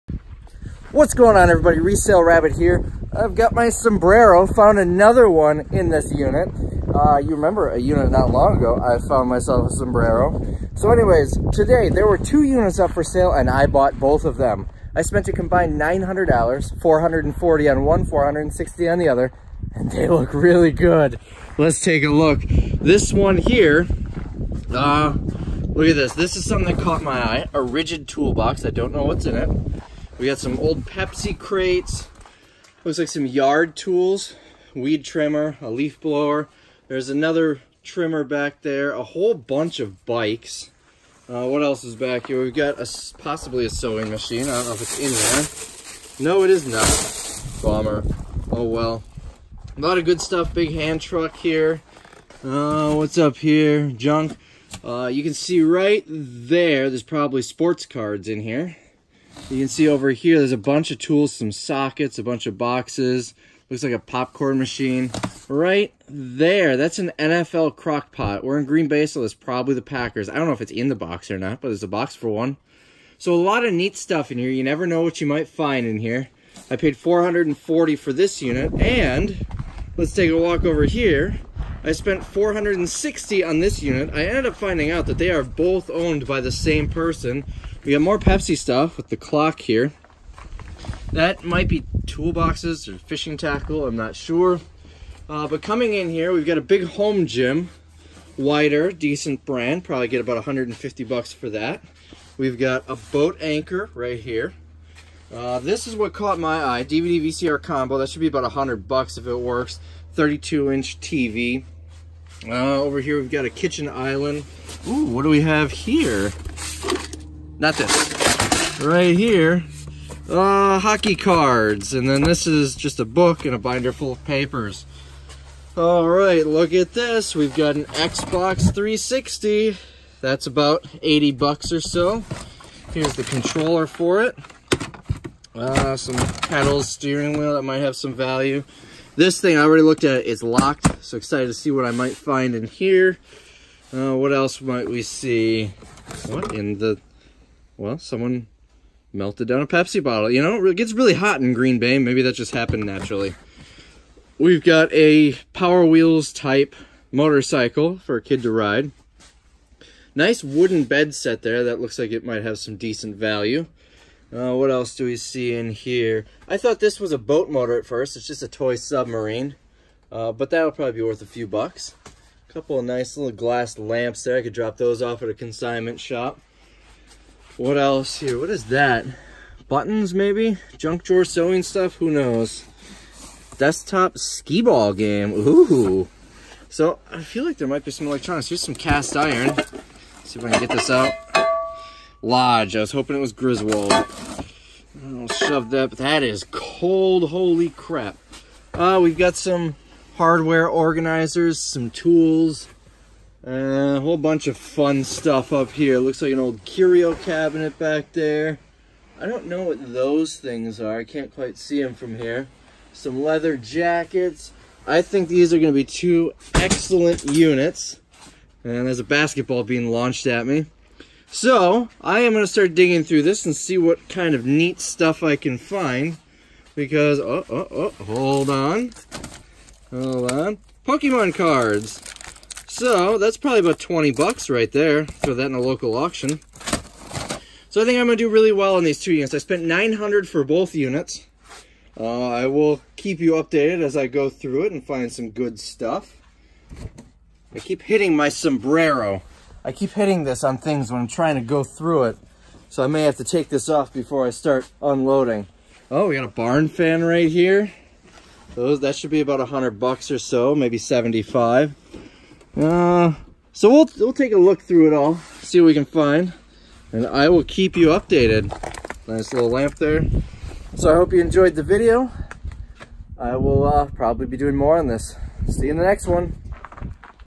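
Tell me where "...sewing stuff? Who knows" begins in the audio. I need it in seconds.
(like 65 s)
181 s.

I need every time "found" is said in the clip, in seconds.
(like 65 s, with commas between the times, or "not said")
4 s, 9 s.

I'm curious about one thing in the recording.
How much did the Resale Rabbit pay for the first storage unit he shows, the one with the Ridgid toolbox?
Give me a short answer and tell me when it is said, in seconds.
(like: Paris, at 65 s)
$440, at 16 s.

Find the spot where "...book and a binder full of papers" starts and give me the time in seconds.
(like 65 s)
123 s.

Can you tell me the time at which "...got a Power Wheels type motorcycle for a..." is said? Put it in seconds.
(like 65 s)
154 s.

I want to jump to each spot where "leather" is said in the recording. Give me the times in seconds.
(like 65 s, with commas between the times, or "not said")
213 s.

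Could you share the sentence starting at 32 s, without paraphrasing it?
Looks like some yard tools, weed trimmer, a leaf blower.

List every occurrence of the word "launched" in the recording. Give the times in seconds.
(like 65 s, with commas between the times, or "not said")
219 s.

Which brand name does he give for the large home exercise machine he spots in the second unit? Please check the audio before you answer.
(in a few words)
Weider.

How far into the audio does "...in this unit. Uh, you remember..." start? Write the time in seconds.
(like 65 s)
5 s.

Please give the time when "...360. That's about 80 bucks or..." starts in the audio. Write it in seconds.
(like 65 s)
128 s.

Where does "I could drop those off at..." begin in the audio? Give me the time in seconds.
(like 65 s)
174 s.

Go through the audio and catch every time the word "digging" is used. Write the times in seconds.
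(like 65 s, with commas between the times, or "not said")
222 s.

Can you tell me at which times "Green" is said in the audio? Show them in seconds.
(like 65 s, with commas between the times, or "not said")
68 s, 151 s.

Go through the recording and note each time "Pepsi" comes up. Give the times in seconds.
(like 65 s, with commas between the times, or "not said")
30 s, 88 s, 149 s.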